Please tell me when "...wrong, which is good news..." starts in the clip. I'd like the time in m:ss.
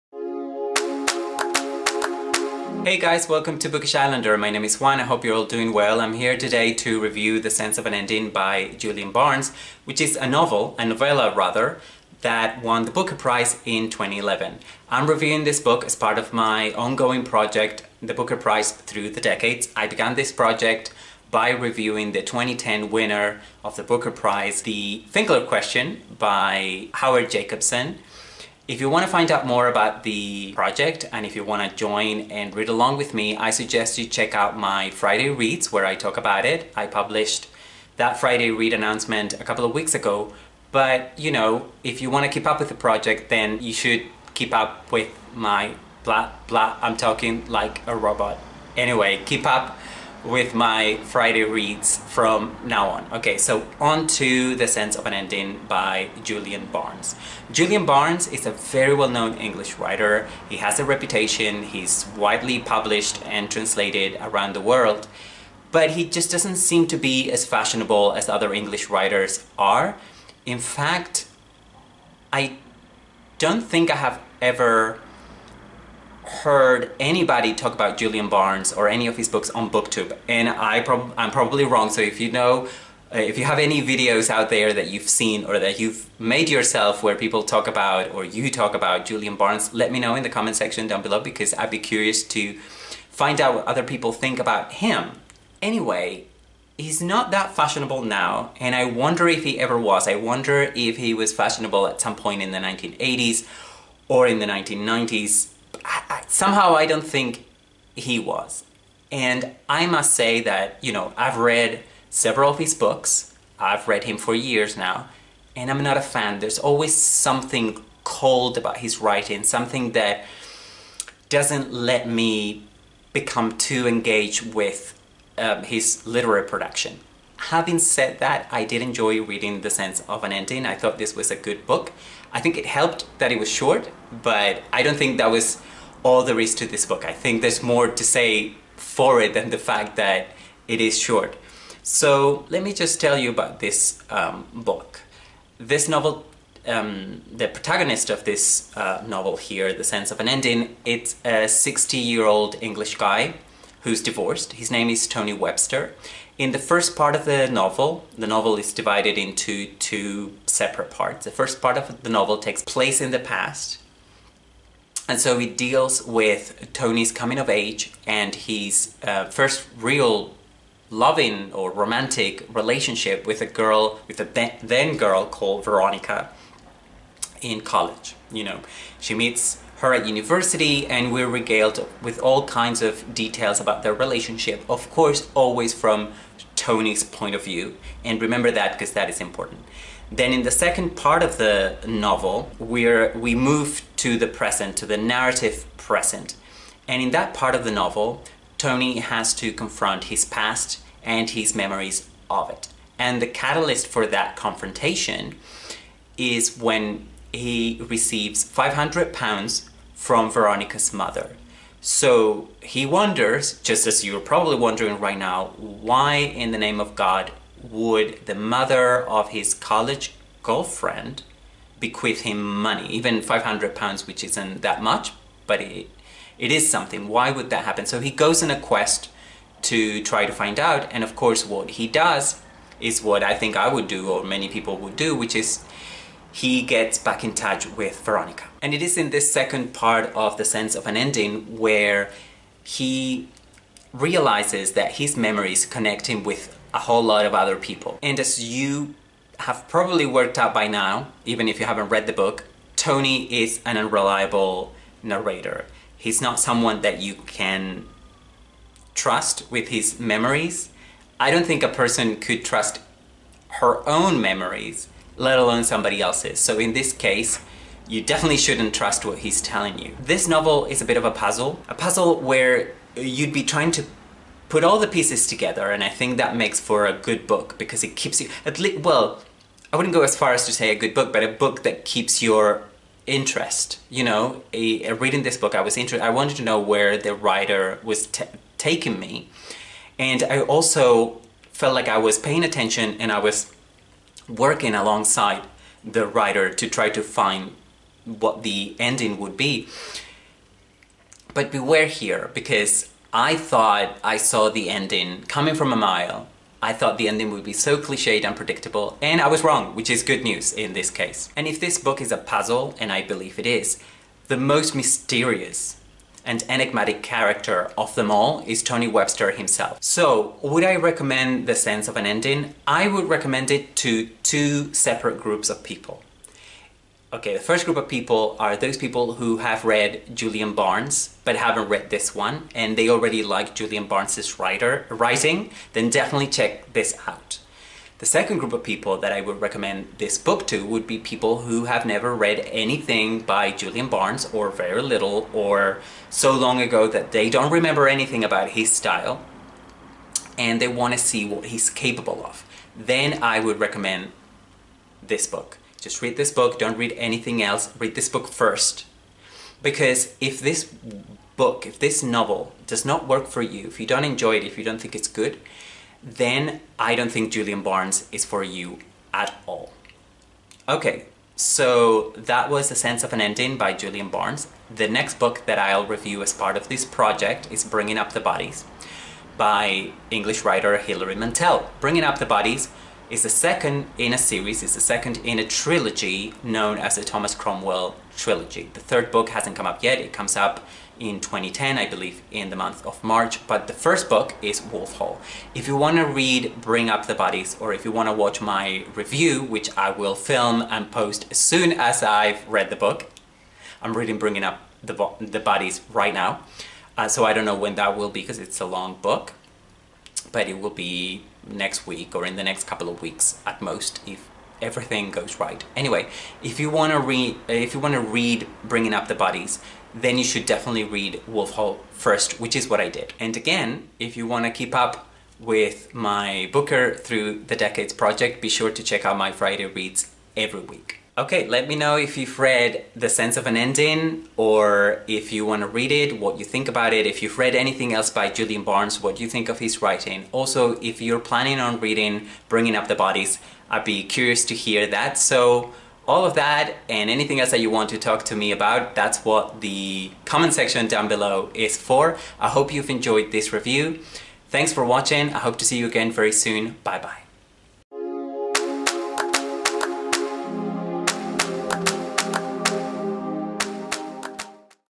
5:09.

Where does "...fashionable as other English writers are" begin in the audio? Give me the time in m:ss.
1:07.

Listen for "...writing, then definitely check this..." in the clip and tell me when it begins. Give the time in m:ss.
5:34.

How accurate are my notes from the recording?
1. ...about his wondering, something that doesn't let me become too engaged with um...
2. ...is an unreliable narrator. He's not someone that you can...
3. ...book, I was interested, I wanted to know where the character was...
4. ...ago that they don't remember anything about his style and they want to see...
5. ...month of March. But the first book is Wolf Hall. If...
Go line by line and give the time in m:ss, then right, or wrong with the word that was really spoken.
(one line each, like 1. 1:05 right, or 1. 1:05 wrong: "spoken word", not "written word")
1. 1:58 wrong: "writing", not "wondering"
2. 4:13 right
3. 4:45 wrong: "writer", not "character"
4. 5:46 right
5. 6:32 right.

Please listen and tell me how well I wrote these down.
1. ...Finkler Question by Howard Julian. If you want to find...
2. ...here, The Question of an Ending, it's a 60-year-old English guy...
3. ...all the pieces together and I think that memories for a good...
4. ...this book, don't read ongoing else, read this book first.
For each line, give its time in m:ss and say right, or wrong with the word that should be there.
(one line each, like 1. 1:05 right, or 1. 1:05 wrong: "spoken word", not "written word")
1. 0:25 wrong: "Jacobson", not "Julian"
2. 2:29 wrong: "Sense", not "Question"
3. 4:34 wrong: "makes", not "memories"
4. 5:56 wrong: "anything", not "ongoing".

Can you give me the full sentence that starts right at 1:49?
And I must say that, you know, I've read several of his books.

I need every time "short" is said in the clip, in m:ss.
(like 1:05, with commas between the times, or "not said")
2:13, 2:20.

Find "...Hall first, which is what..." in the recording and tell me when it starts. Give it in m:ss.
7:01.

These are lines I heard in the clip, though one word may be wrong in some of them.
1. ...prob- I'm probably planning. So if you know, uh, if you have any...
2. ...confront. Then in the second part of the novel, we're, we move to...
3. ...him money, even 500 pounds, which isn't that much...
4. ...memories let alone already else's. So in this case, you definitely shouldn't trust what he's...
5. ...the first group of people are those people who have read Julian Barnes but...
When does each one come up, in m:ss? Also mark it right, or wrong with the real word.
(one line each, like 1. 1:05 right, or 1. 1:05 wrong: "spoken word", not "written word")
1. 1:20 wrong: "wrong", not "planning"
2. 3:09 wrong: "important", not "confront"
3. 3:42 right
4. 4:24 wrong: "somebody", not "already"
5. 5:27 right.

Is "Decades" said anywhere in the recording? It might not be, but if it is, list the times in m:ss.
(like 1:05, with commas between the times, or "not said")
0:19, 7:07.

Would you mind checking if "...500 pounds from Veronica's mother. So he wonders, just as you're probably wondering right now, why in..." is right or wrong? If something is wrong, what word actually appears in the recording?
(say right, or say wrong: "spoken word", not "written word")
right.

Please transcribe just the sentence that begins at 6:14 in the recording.
The next book that I'll review as part of this project is Bringing Up the Bodies by English writer Hilary Mantel.